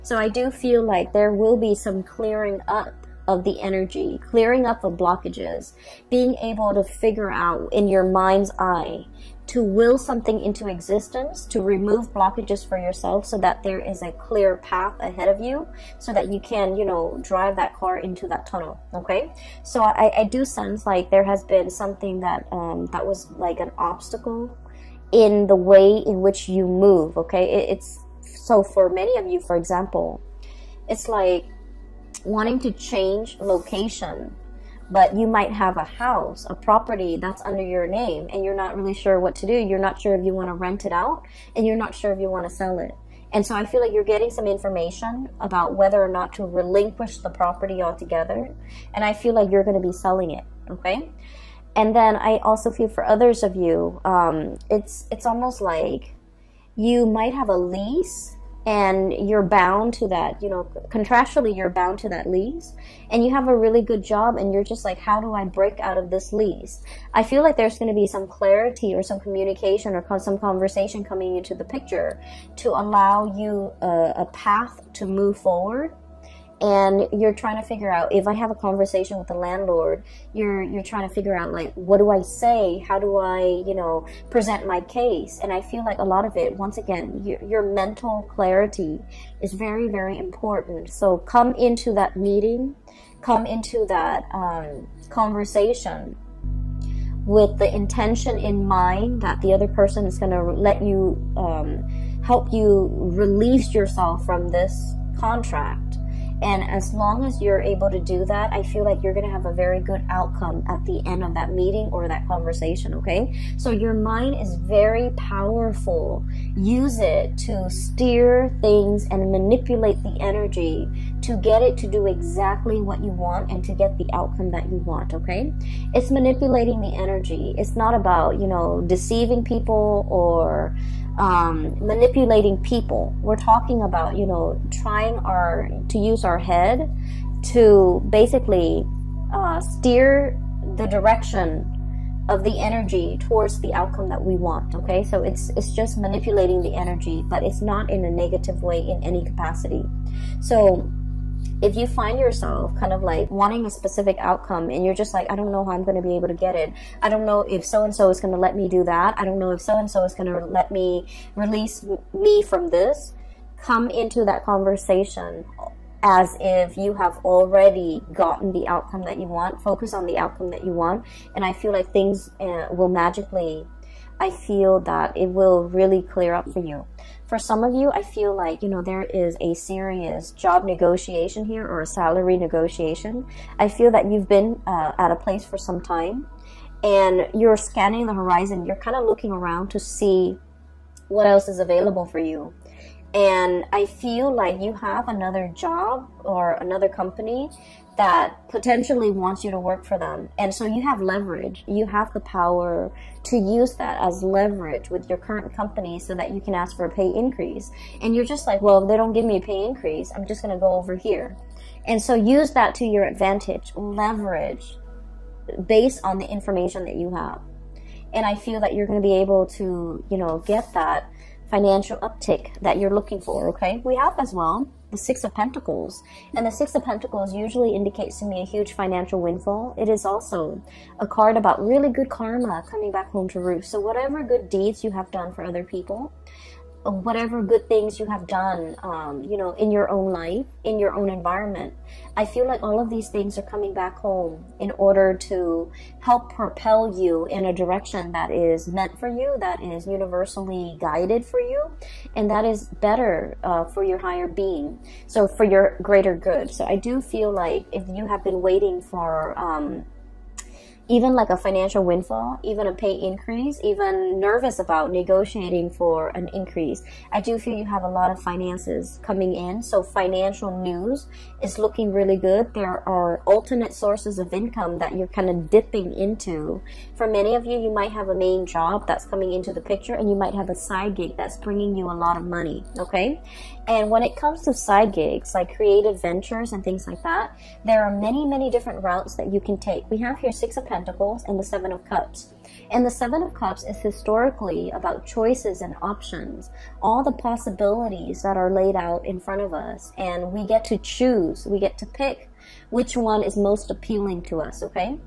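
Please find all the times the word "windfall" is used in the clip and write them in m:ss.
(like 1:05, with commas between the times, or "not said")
3:49, 4:21.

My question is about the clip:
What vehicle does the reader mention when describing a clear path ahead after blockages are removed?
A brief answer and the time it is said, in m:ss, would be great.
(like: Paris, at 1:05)
car, at 0:17.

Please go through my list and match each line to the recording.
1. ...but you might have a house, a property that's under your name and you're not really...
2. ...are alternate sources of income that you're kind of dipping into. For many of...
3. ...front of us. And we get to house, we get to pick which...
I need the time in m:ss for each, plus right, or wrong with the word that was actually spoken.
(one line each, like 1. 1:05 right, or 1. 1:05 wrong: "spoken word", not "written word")
1. 0:34 right
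2. 4:32 right
3. 4:59 wrong: "choose", not "house".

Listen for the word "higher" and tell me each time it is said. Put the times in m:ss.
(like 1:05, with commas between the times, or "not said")
4:13.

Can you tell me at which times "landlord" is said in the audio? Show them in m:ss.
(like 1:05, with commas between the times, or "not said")
1:19.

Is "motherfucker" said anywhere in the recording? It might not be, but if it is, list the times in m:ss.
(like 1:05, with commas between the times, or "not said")
not said.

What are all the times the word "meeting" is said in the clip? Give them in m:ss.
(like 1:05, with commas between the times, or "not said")
1:32, 1:51.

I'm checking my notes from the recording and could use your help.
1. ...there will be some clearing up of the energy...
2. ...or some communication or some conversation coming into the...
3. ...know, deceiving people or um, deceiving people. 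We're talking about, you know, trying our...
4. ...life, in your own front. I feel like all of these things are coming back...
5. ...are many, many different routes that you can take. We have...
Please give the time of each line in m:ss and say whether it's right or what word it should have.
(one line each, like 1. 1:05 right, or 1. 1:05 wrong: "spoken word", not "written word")
1. 0:01 right
2. 1:08 right
3. 2:08 wrong: "manipulating", not "deceiving"
4. 4:00 wrong: "environment", not "front"
5. 4:47 right.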